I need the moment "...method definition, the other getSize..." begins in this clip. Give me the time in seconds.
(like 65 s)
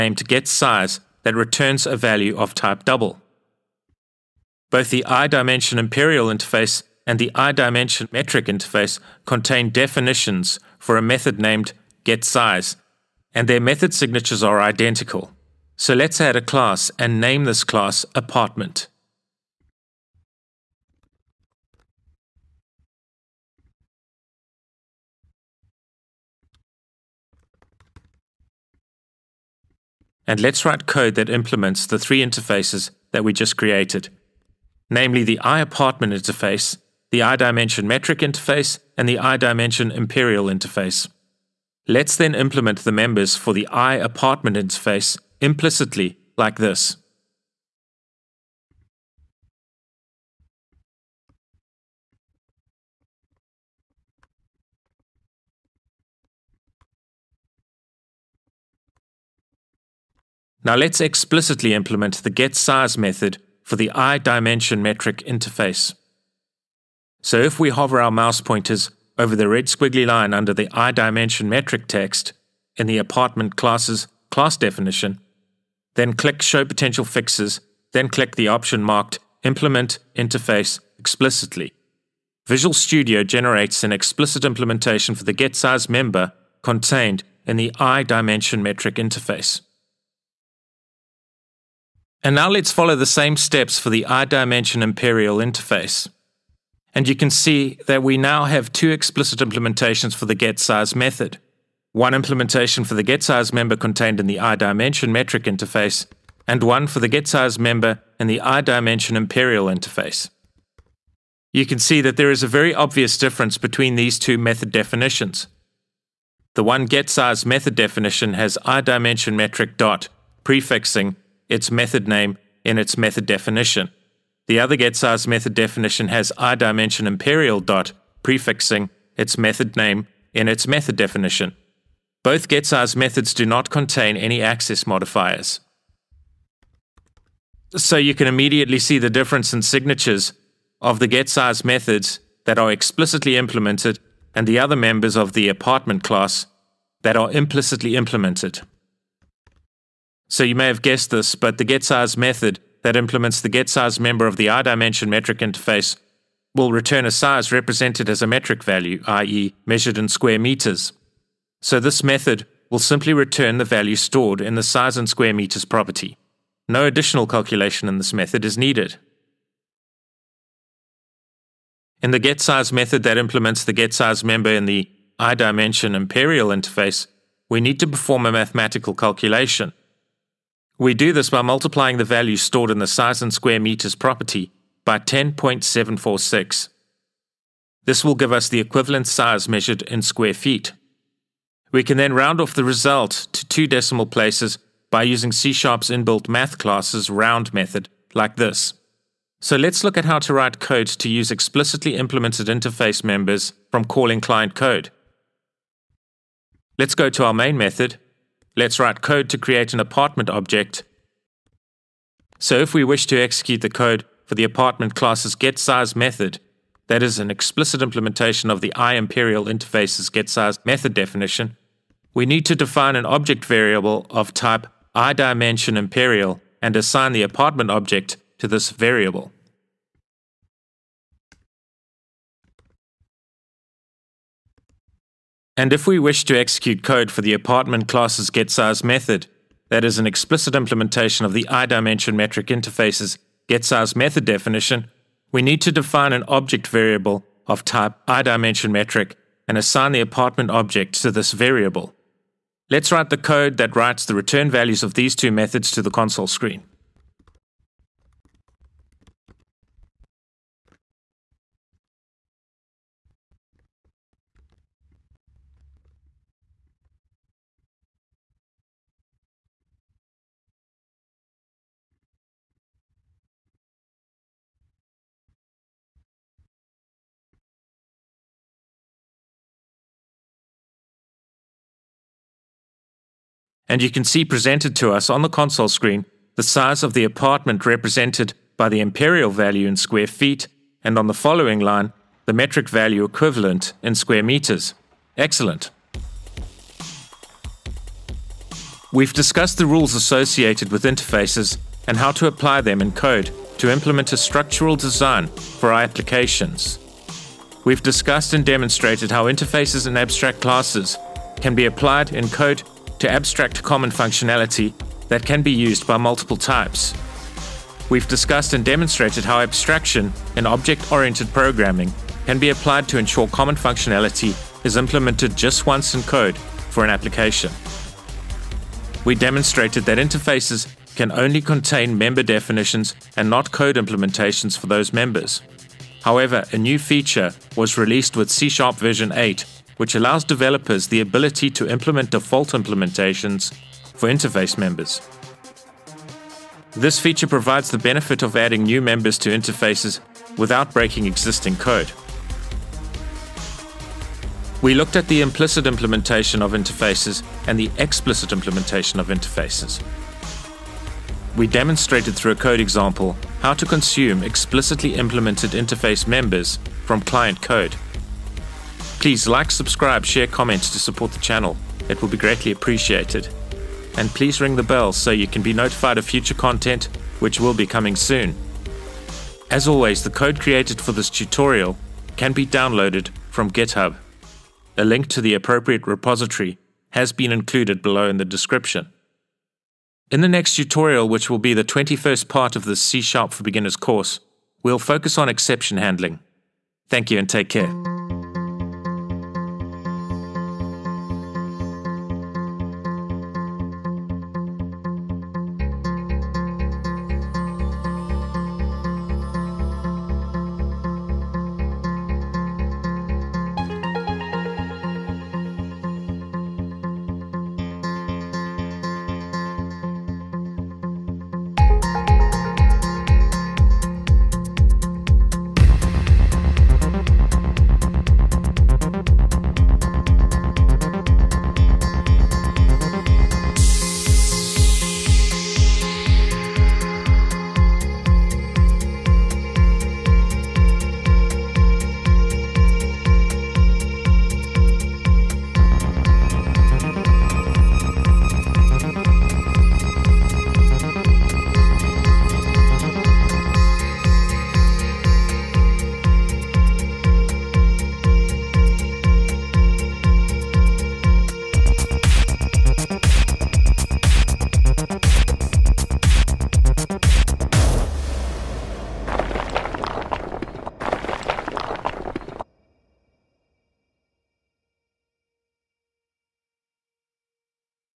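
122 s.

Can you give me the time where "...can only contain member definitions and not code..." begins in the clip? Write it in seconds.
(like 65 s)
330 s.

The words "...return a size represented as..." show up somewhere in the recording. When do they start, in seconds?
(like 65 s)
156 s.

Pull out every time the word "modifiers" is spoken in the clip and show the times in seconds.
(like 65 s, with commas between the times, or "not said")
134 s.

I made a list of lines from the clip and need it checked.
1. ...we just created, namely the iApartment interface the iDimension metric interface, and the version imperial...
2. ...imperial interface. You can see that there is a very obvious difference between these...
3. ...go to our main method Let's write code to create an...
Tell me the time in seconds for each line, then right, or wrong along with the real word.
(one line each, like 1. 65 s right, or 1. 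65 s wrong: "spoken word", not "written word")
1. 33 s wrong: "iDimension", not "version"
2. 109 s right
3. 206 s right.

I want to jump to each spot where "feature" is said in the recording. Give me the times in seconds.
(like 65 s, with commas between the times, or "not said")
336 s, 346 s.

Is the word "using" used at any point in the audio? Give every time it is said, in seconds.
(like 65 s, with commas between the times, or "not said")
195 s.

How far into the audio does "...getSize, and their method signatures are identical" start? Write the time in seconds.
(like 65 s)
12 s.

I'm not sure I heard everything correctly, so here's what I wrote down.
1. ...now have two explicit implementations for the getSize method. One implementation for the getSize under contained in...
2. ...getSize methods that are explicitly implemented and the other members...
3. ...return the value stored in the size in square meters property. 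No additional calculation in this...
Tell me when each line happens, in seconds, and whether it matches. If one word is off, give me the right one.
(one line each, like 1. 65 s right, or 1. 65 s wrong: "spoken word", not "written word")
1. 98 s wrong: "member", not "under"
2. 141 s right
3. 163 s right.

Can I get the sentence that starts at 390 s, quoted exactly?
In the next tutorial, which will be the 21st part of the C Sharp for Beginners course, we'll focus on exception handling.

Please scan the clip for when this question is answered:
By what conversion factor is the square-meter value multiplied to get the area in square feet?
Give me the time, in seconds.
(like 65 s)
184 s.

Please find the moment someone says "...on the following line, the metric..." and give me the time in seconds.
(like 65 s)
290 s.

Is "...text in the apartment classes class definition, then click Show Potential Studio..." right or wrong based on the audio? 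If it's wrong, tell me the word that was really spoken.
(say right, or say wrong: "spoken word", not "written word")
wrong: "Fixes", not "Studio".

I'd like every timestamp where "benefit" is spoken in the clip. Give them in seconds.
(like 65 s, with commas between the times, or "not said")
347 s.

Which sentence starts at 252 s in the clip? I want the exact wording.
Let's write the code that writes the return values of these two methods to the console screen.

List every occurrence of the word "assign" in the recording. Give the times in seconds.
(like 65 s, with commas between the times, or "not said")
226 s, 249 s.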